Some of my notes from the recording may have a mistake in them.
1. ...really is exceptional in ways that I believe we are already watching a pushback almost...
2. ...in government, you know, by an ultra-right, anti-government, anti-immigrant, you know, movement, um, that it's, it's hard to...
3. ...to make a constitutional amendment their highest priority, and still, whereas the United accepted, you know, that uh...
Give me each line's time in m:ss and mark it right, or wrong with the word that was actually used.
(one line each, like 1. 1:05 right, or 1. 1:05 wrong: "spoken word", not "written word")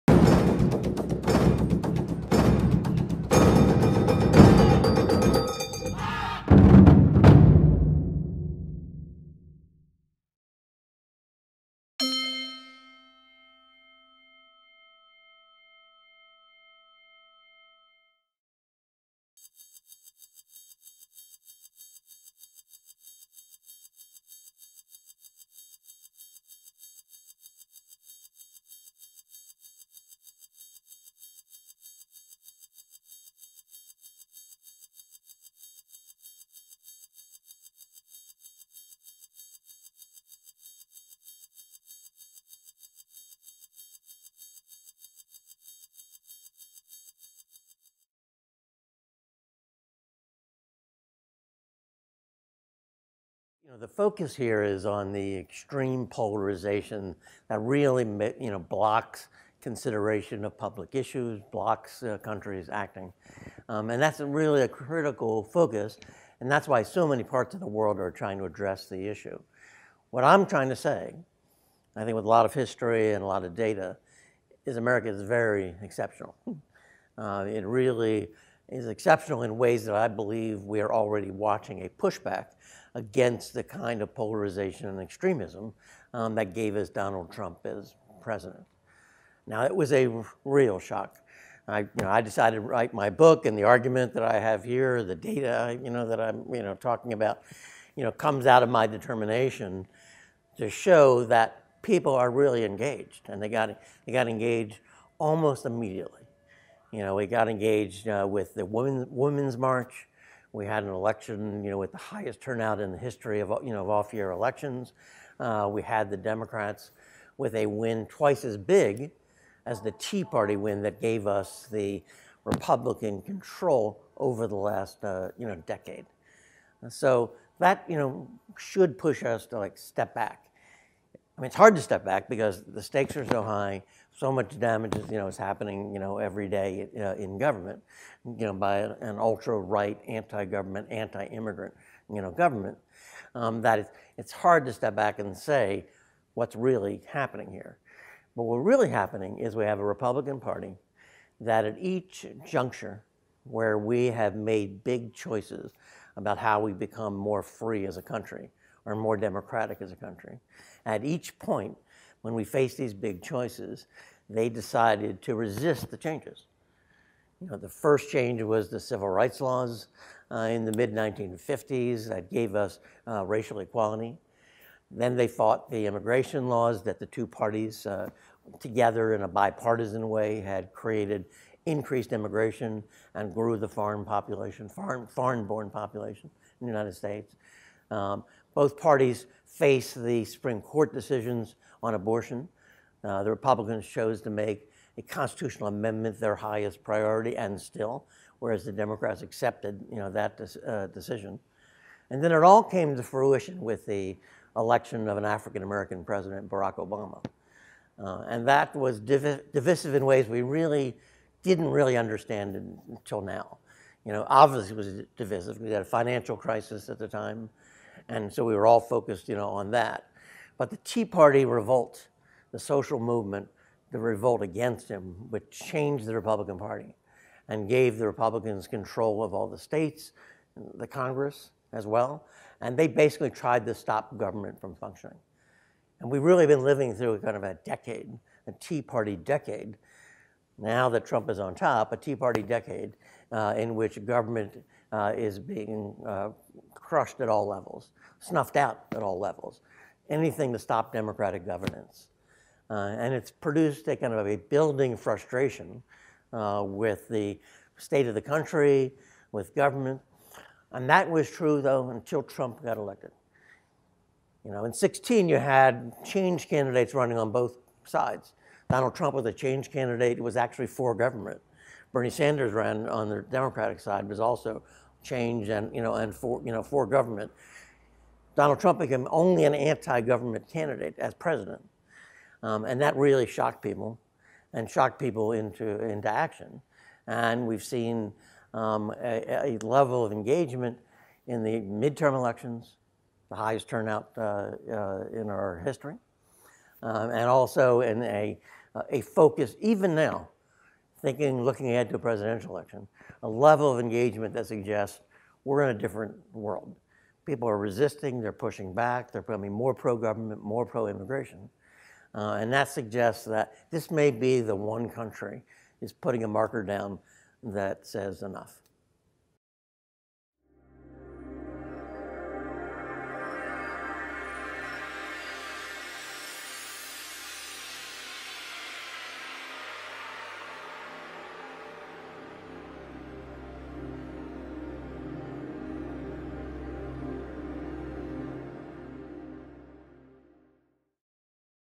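1. 1:17 wrong: "against", not "almost"
2. 2:17 wrong: "government", not "movement"
3. 3:14 wrong: "Democrats", not "United".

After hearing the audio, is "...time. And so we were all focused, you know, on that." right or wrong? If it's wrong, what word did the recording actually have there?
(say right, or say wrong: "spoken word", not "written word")
right.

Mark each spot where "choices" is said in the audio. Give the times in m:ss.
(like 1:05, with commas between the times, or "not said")
2:35, 2:43.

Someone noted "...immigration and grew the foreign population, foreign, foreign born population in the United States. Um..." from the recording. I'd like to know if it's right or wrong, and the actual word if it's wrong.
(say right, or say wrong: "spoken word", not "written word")
right.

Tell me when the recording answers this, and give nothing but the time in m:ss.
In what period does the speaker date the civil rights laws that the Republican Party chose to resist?
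2:50.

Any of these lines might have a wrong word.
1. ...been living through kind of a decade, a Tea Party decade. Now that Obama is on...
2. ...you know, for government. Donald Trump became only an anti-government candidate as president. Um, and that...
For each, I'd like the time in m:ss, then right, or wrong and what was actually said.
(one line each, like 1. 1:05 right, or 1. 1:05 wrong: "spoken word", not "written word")
1. 3:56 wrong: "Trump", not "Obama"
2. 4:36 right.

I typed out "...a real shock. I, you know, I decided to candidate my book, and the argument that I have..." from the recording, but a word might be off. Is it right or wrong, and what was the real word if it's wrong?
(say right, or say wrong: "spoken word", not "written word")
wrong: "write", not "candidate".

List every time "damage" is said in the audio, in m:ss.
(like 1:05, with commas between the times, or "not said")
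2:14.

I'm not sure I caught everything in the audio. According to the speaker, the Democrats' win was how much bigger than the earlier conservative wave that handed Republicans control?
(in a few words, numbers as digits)
twice as big.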